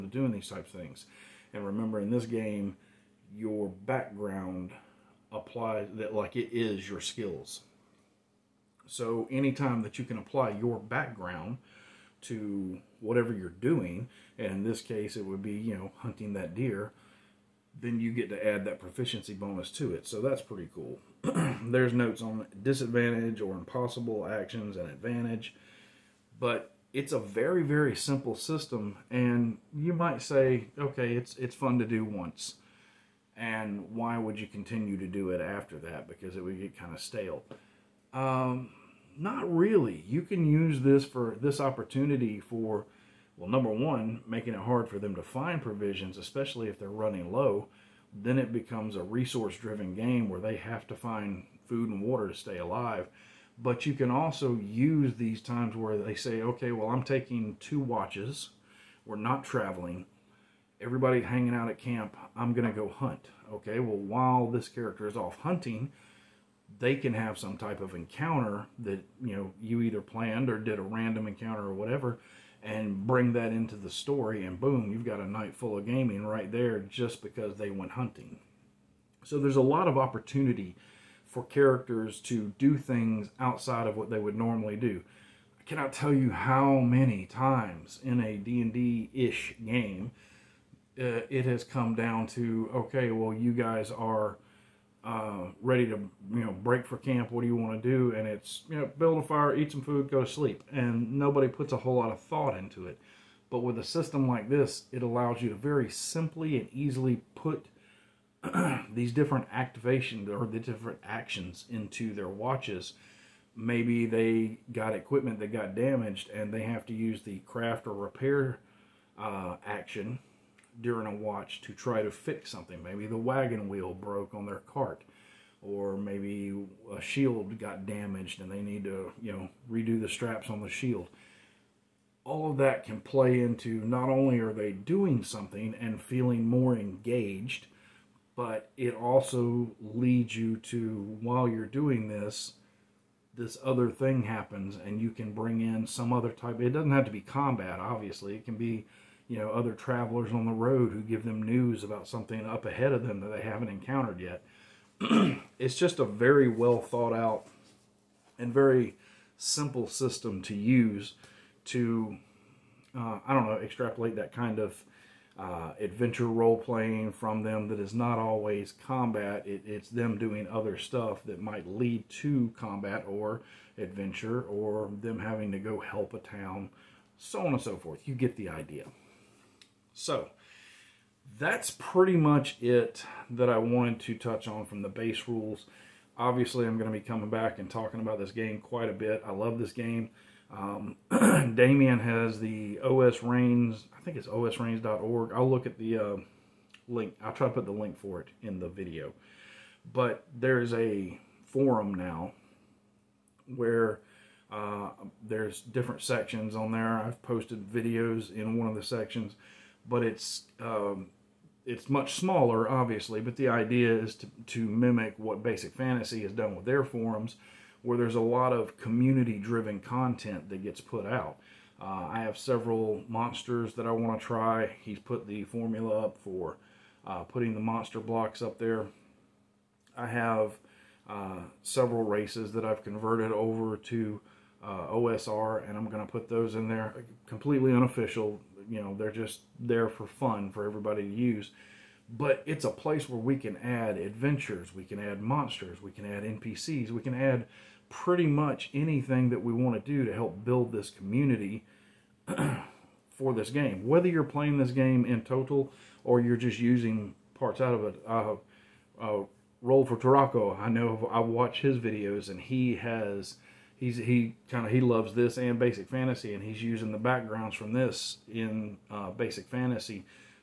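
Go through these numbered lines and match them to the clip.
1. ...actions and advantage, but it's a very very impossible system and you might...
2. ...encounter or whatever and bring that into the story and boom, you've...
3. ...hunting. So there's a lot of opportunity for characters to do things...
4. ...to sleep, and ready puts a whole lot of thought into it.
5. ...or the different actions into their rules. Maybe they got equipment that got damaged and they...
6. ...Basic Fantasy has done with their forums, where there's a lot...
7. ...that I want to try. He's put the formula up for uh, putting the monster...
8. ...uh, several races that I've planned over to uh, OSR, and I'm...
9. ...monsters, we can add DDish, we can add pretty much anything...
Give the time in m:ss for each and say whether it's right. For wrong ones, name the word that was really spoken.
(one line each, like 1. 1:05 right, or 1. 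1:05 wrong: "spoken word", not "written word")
1. 0:24 wrong: "simple", not "impossible"
2. 1:11 right
3. 1:17 right
4. 1:40 wrong: "nobody", not "ready"
5. 1:50 wrong: "watches", not "rules"
6. 3:35 right
7. 3:43 right
8. 3:51 wrong: "converted", not "planned"
9. 4:05 wrong: "NPCs", not "DDish".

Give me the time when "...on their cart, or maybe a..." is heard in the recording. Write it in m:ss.
2:04.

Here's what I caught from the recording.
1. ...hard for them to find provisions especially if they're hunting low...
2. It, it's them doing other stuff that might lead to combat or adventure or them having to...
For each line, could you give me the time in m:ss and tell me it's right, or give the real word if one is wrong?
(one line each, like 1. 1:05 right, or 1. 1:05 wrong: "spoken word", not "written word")
1. 0:44 wrong: "running", not "hunting"
2. 2:49 right.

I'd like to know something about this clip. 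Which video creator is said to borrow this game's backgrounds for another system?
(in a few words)
Roll for Taraco.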